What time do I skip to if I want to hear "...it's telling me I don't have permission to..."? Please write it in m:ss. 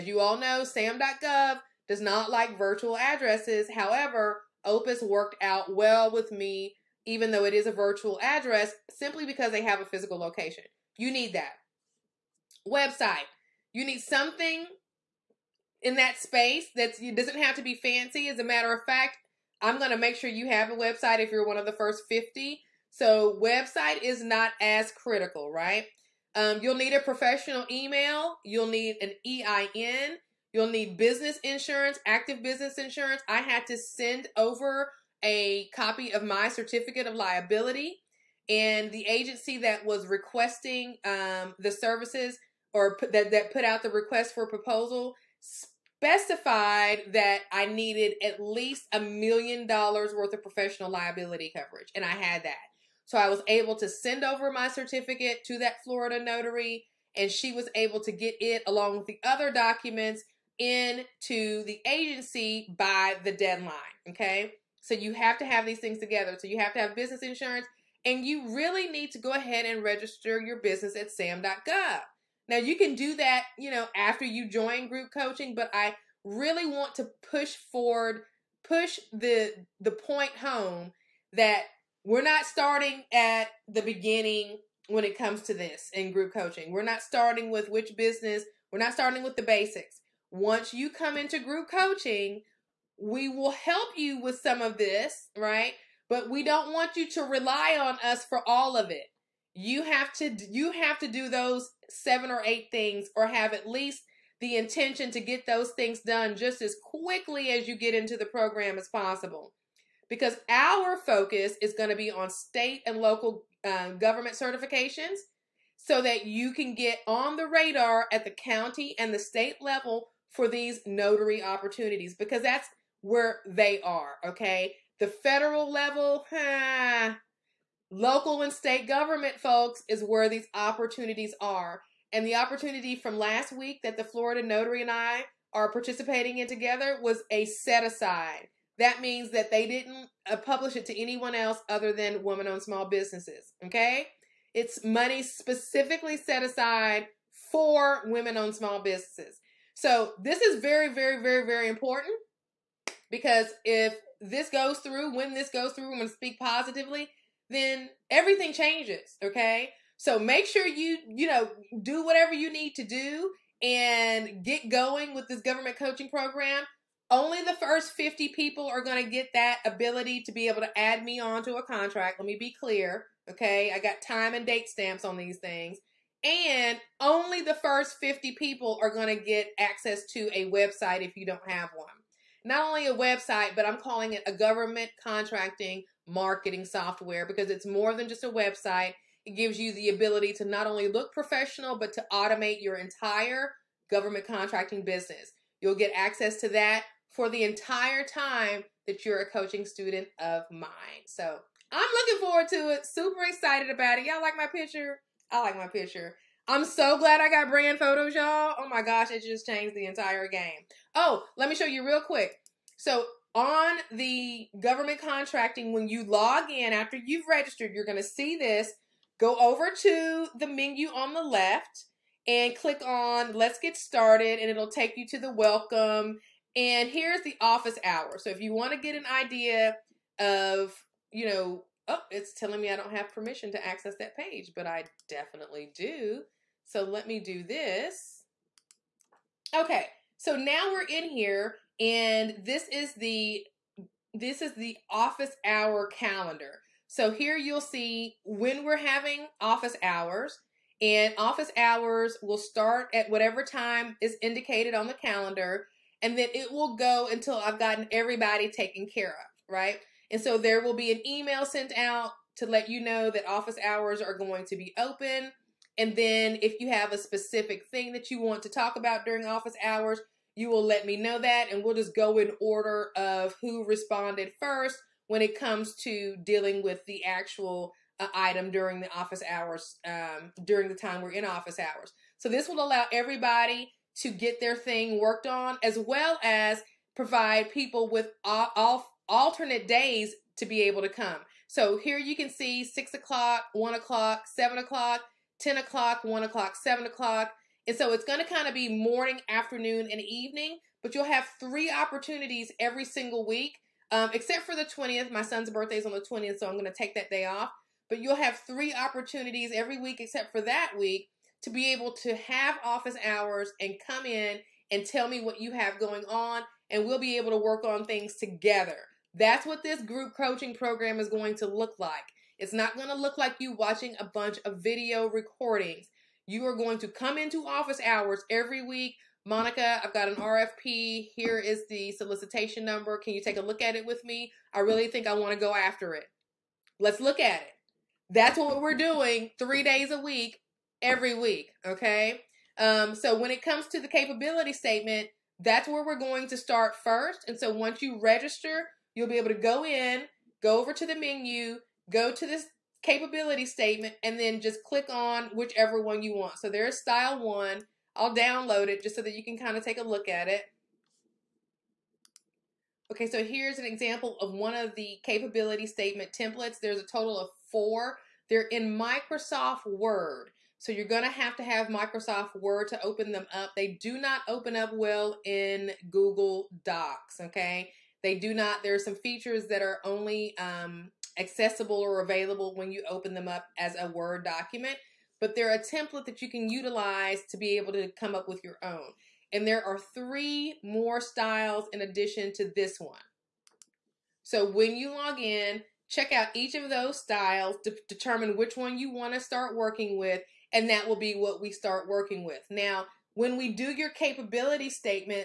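3:52.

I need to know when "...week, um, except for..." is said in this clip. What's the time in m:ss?
5:03.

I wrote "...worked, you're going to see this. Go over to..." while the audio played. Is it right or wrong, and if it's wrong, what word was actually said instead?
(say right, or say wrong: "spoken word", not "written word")
wrong: "registered", not "worked".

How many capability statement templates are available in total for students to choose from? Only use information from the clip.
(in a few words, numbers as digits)
4.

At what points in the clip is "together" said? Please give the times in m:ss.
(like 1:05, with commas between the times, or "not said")
1:05, 2:16, 5:18.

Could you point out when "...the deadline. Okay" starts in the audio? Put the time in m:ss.
1:03.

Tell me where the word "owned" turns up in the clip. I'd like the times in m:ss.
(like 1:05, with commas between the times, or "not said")
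2:22, 2:28.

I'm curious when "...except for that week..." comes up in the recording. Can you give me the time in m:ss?
5:10.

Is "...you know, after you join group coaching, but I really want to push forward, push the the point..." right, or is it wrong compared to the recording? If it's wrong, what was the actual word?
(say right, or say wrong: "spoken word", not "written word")
right.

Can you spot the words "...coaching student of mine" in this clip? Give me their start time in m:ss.
3:19.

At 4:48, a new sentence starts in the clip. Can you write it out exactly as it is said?
all alternate days to be able to come.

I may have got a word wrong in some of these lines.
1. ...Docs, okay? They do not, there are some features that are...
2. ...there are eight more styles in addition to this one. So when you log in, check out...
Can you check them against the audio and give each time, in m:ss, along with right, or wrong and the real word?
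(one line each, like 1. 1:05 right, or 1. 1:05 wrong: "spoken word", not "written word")
1. 6:16 right
2. 6:29 wrong: "three", not "eight".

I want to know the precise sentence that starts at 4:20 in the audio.
And so there will be an email sent out to let you know that office hours are going to be open.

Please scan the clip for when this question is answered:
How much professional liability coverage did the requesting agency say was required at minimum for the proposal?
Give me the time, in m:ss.
0:48.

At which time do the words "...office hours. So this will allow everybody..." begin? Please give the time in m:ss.
4:41.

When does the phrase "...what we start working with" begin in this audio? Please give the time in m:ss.
6:41.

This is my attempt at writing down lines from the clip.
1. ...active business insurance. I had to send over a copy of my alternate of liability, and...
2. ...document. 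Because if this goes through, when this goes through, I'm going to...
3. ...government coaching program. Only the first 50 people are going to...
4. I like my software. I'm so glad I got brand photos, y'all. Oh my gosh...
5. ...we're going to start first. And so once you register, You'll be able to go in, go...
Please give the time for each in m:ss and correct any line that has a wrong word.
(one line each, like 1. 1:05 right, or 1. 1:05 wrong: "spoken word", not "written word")
1. 0:32 wrong: "certificate", not "alternate"
2. 2:31 wrong: "important", not "document"
3. 2:45 right
4. 3:25 wrong: "picture", not "software"
5. 5:45 right.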